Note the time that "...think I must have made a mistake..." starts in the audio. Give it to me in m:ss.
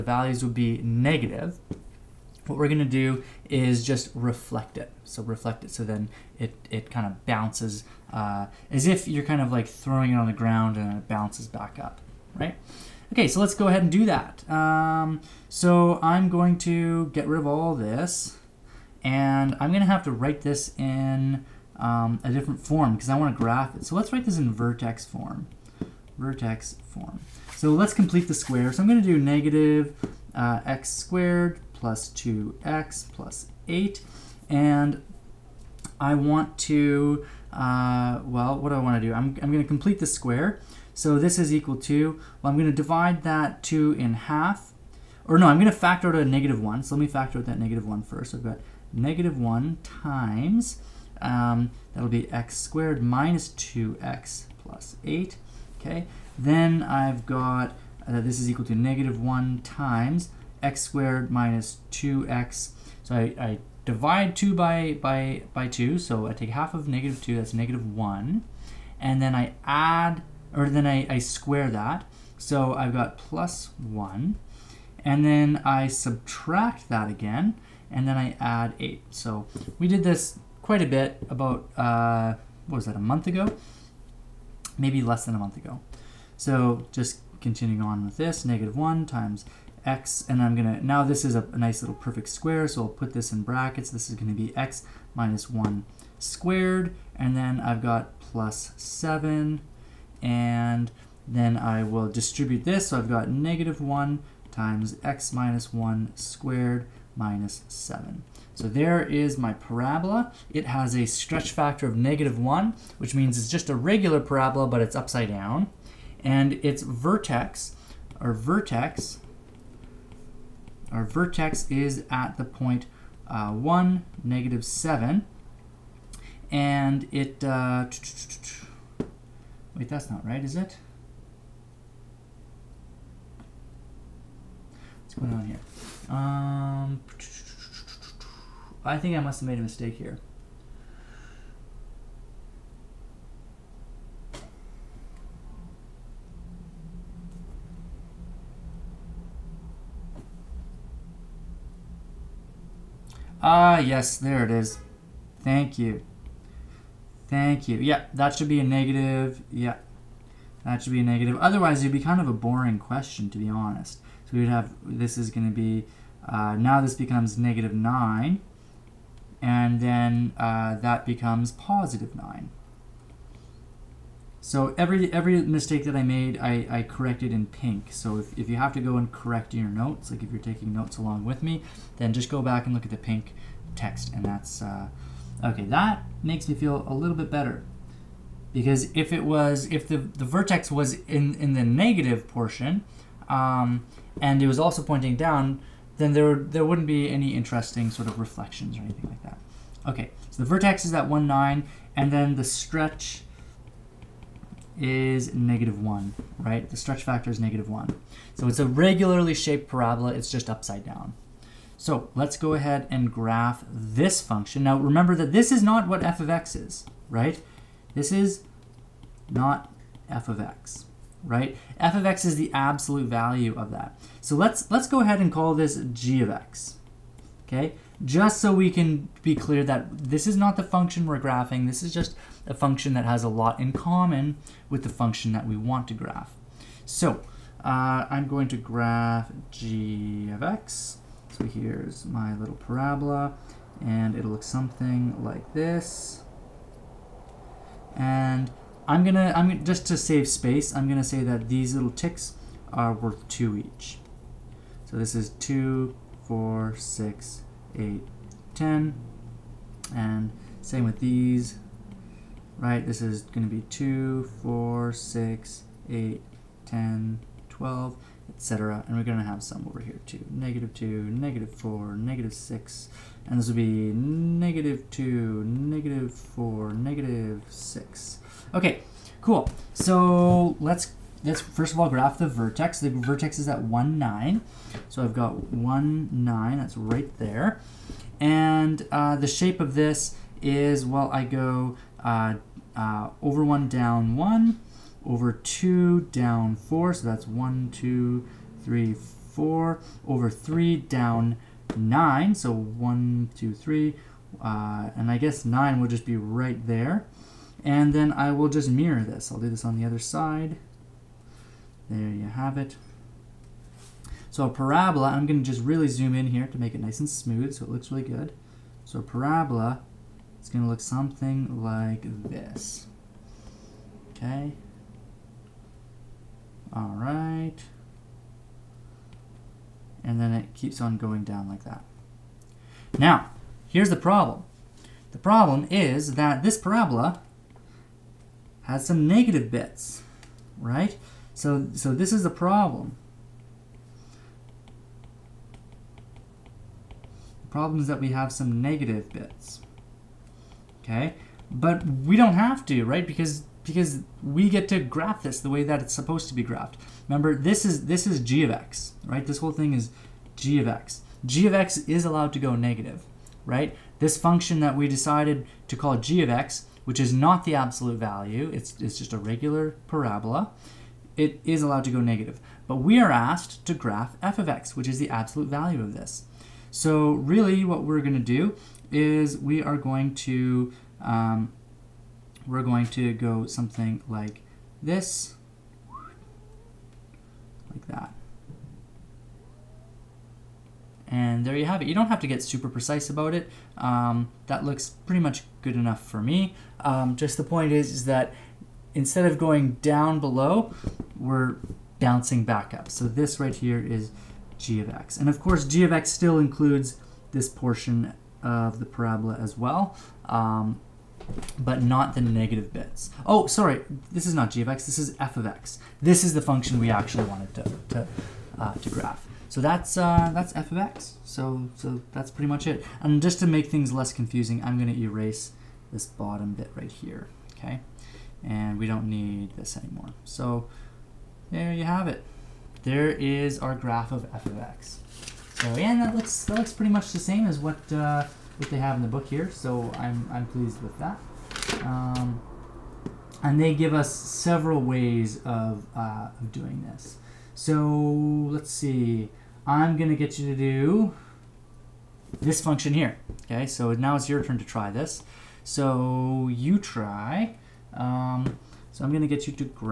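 2:18.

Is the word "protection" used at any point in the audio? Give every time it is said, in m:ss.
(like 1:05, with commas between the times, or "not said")
not said.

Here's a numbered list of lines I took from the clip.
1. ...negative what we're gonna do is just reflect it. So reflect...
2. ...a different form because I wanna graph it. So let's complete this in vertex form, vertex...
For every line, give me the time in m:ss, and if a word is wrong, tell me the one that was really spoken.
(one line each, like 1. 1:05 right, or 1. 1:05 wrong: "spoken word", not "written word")
1. 0:00 right
2. 0:22 wrong: "write", not "complete".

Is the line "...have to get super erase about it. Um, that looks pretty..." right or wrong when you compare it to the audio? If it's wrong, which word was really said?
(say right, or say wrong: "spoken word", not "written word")
wrong: "precise", not "erase".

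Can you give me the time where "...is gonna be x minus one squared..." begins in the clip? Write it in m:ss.
1:34.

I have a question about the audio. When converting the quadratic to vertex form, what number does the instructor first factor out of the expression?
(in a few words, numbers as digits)
-1.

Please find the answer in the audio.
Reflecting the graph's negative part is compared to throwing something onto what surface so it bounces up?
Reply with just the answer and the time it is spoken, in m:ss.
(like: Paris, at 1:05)
the ground, at 0:10.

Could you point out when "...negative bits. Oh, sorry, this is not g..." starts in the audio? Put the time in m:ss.
6:52.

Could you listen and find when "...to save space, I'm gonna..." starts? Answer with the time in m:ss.
4:09.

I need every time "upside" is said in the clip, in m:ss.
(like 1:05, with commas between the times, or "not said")
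1:54, 3:30.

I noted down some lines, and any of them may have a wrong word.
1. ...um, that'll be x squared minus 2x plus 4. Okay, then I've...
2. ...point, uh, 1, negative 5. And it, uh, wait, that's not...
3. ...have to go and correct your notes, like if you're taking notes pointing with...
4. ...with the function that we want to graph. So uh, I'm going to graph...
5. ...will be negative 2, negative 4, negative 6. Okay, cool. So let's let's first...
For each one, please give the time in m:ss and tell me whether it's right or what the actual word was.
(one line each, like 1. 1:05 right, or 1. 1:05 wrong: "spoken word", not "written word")
1. 0:51 wrong: "8", not "4"
2. 2:02 wrong: "7", not "5"
3. 2:58 wrong: "along", not "pointing"
4. 3:54 right
5. 4:33 right.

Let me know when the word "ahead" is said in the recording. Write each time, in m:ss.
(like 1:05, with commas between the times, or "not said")
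0:13, 3:32, 3:45.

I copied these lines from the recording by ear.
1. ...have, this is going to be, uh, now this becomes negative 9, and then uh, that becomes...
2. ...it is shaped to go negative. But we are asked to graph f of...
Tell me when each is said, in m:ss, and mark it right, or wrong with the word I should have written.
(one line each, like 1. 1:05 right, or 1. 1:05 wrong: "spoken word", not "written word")
1. 2:44 right
2. 6:11 wrong: "allowed", not "shaped".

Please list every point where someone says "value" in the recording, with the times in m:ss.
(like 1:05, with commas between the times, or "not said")
0:00, 3:43, 6:07, 6:15.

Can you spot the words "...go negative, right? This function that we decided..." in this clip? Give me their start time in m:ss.
6:02.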